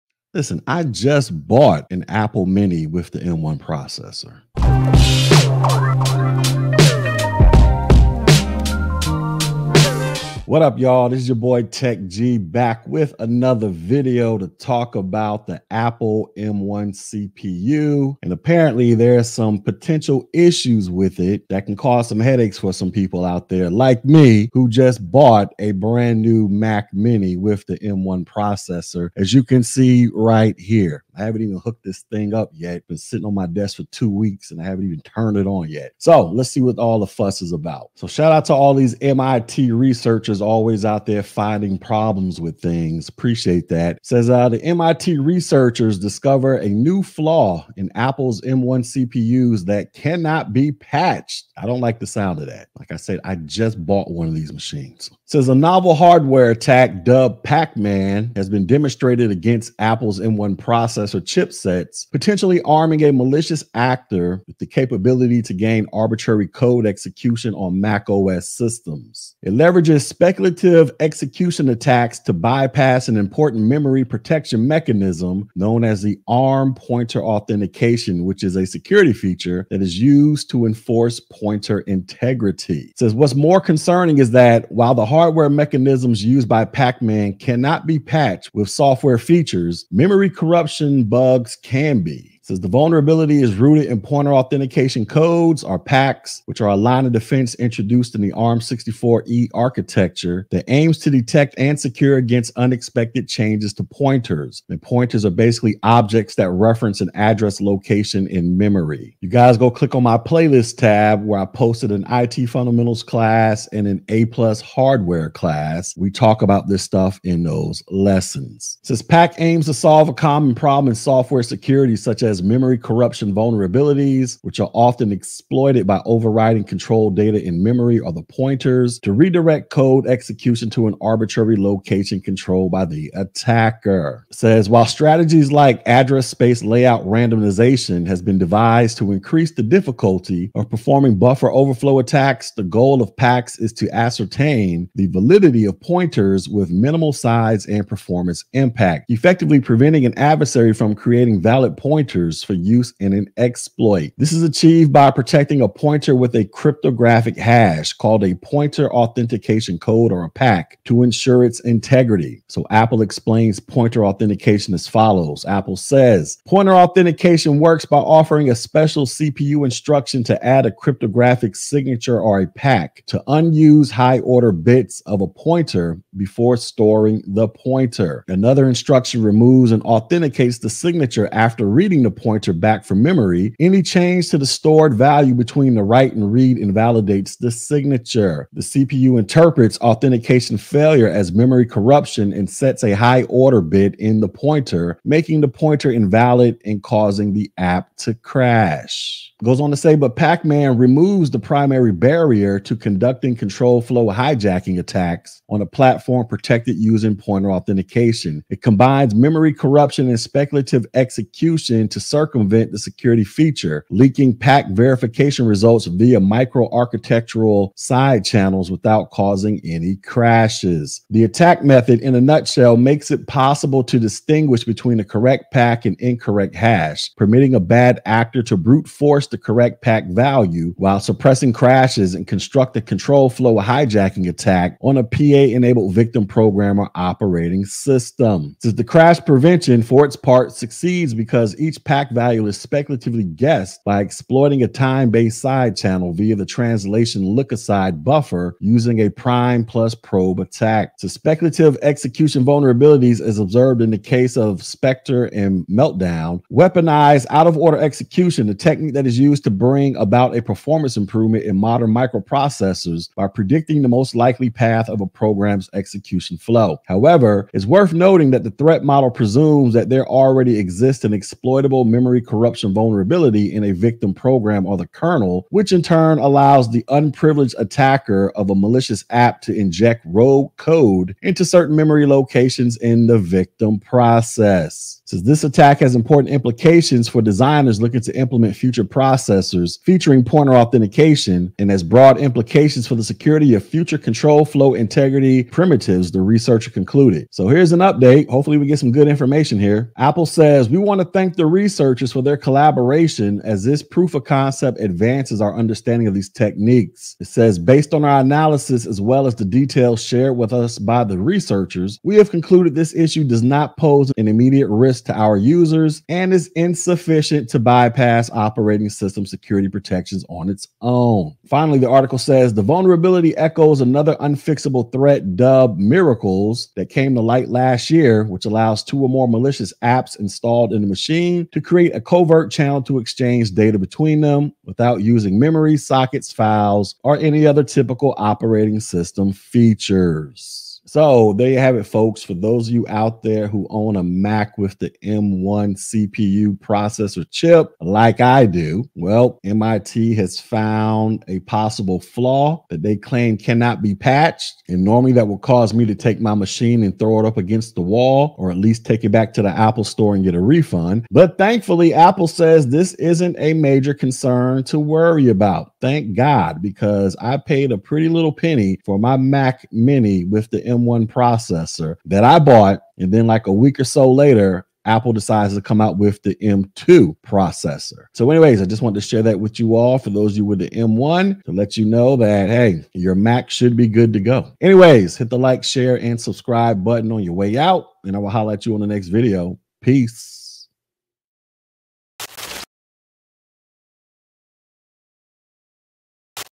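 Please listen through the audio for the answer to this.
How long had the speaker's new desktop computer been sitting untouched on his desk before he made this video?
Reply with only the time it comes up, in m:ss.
0:33.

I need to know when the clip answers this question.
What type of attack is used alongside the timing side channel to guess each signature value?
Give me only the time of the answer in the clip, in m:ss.
4:09.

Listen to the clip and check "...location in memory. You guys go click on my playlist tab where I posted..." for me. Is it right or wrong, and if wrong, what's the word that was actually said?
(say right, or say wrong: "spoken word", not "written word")
right.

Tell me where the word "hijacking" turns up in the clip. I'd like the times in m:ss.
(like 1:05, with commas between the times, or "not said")
3:24, 3:53.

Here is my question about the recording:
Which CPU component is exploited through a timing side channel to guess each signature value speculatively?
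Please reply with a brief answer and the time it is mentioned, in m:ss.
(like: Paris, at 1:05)
translation look aside buffer, at 4:06.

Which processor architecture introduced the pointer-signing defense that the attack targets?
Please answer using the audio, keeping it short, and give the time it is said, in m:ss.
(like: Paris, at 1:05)
ARM64E, at 1:38.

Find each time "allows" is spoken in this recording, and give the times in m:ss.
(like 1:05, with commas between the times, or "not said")
4:36, 5:28.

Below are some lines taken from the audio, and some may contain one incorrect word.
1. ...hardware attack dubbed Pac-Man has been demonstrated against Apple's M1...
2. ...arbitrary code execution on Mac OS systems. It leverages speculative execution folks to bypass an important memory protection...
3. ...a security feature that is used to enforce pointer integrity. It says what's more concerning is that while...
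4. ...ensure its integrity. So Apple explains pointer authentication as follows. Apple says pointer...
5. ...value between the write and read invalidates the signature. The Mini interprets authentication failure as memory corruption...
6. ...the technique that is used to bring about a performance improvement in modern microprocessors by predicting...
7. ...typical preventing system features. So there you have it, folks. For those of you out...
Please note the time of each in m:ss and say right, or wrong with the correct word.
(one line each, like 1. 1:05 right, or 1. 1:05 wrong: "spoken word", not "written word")
1. 0:55 right
2. 1:05 wrong: "attacks", not "folks"
3. 1:18 right
4. 2:41 right
5. 3:04 wrong: "CPU", not "Mini"
6. 4:18 right
7. 5:37 wrong: "operating", not "preventing".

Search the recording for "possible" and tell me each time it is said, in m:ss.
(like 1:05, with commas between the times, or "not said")
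3:43, 5:51.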